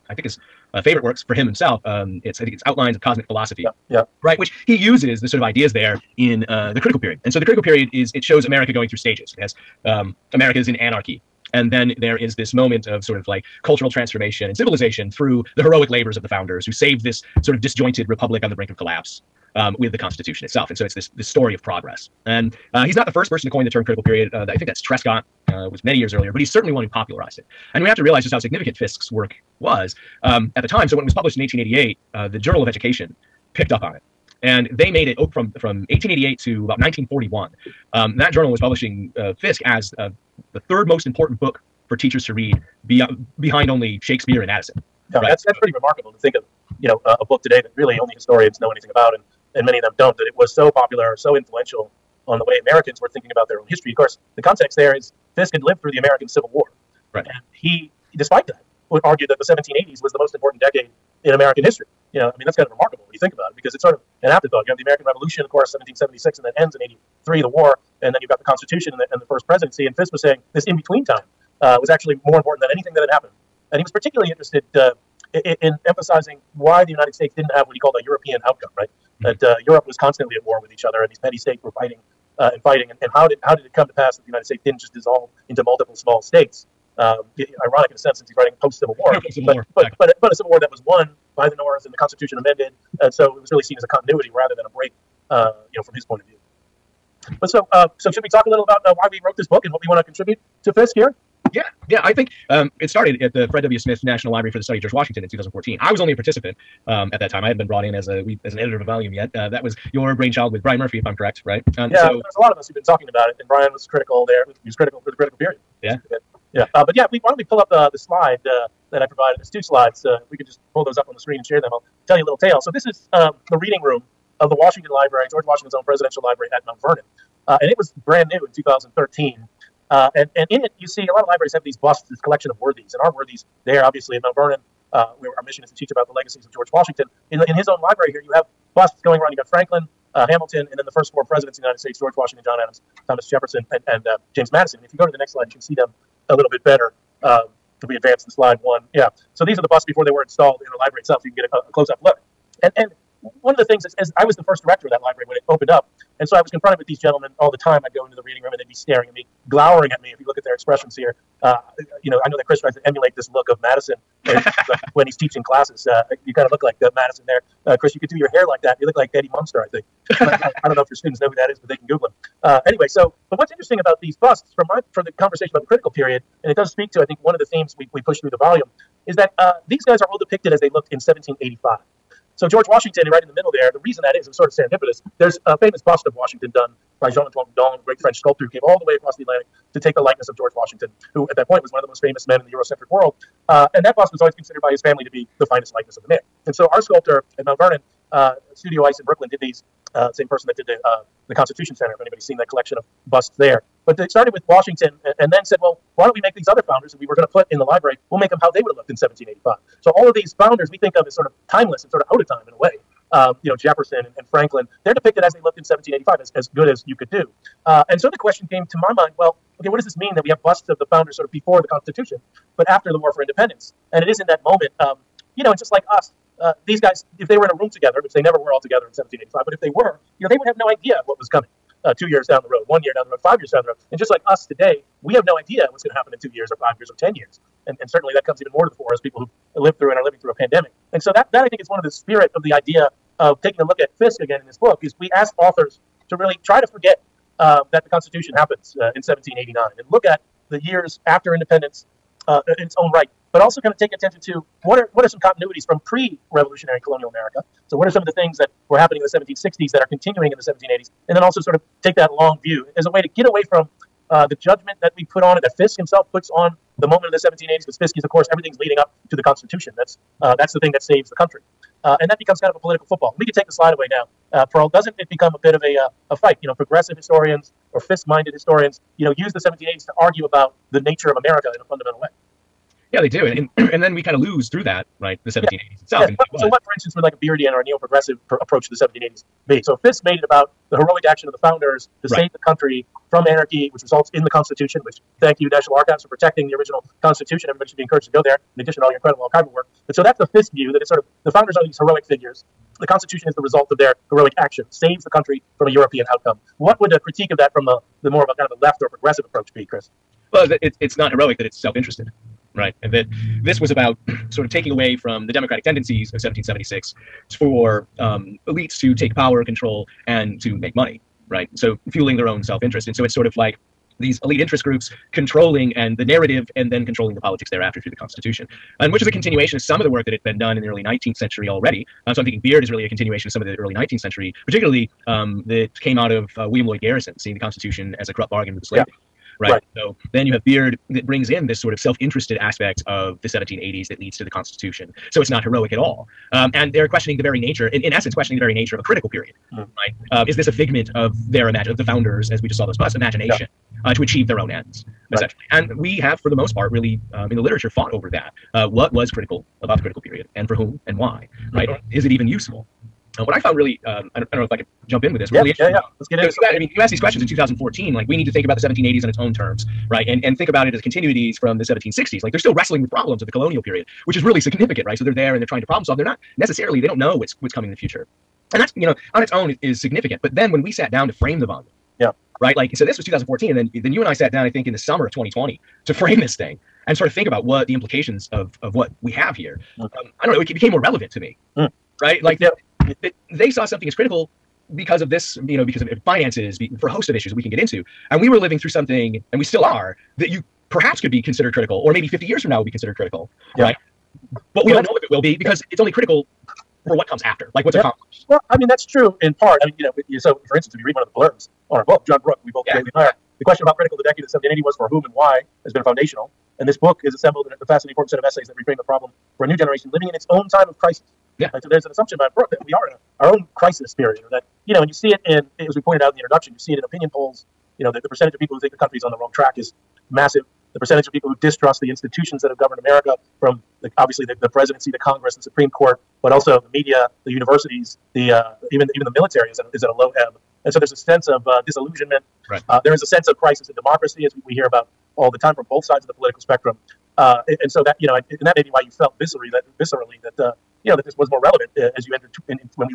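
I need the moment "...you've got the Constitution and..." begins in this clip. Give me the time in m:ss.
1:08.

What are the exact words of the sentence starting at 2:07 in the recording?
Uh, and it was brand new in 2013.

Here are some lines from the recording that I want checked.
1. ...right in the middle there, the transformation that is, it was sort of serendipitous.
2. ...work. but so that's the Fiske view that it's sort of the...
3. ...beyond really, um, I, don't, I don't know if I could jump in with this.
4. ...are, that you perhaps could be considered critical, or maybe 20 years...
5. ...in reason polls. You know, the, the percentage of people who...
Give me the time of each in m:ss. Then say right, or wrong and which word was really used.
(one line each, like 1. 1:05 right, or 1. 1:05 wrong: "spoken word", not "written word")
1. 3:03 wrong: "reason", not "transformation"
2. 4:59 right
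3. 6:03 wrong: "found", not "beyond"
4. 6:39 wrong: "50", not "20"
5. 7:06 wrong: "opinion", not "reason".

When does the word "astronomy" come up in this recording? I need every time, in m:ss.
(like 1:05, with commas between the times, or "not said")
not said.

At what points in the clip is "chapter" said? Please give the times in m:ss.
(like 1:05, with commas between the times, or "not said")
not said.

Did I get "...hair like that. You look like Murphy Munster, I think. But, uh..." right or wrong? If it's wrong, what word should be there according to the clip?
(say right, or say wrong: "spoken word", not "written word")
wrong: "Eddie", not "Murphy".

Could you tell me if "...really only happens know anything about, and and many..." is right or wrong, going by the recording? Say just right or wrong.
wrong.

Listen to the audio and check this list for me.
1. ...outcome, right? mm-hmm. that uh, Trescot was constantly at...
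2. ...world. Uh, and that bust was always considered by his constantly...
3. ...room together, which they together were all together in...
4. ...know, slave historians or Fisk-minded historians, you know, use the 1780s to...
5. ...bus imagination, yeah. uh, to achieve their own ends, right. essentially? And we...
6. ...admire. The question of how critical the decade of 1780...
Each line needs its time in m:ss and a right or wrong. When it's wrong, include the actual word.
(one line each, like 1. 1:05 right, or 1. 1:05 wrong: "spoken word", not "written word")
1. 1:18 wrong: "Europe", not "Trescot"
2. 3:12 wrong: "family", not "constantly"
3. 3:47 wrong: "never", not "together"
4. 4:36 wrong: "progressive", not "slave"
5. 5:52 right
6. 6:52 right.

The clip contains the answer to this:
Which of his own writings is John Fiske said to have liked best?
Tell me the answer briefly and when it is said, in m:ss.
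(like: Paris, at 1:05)
Outlines of Cosmic Philosophy, at 0:02.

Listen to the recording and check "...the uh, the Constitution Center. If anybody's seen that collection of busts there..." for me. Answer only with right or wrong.
right.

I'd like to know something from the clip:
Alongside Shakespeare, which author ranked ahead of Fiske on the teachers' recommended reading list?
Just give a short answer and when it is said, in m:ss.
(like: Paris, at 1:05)
Addison, at 0:44.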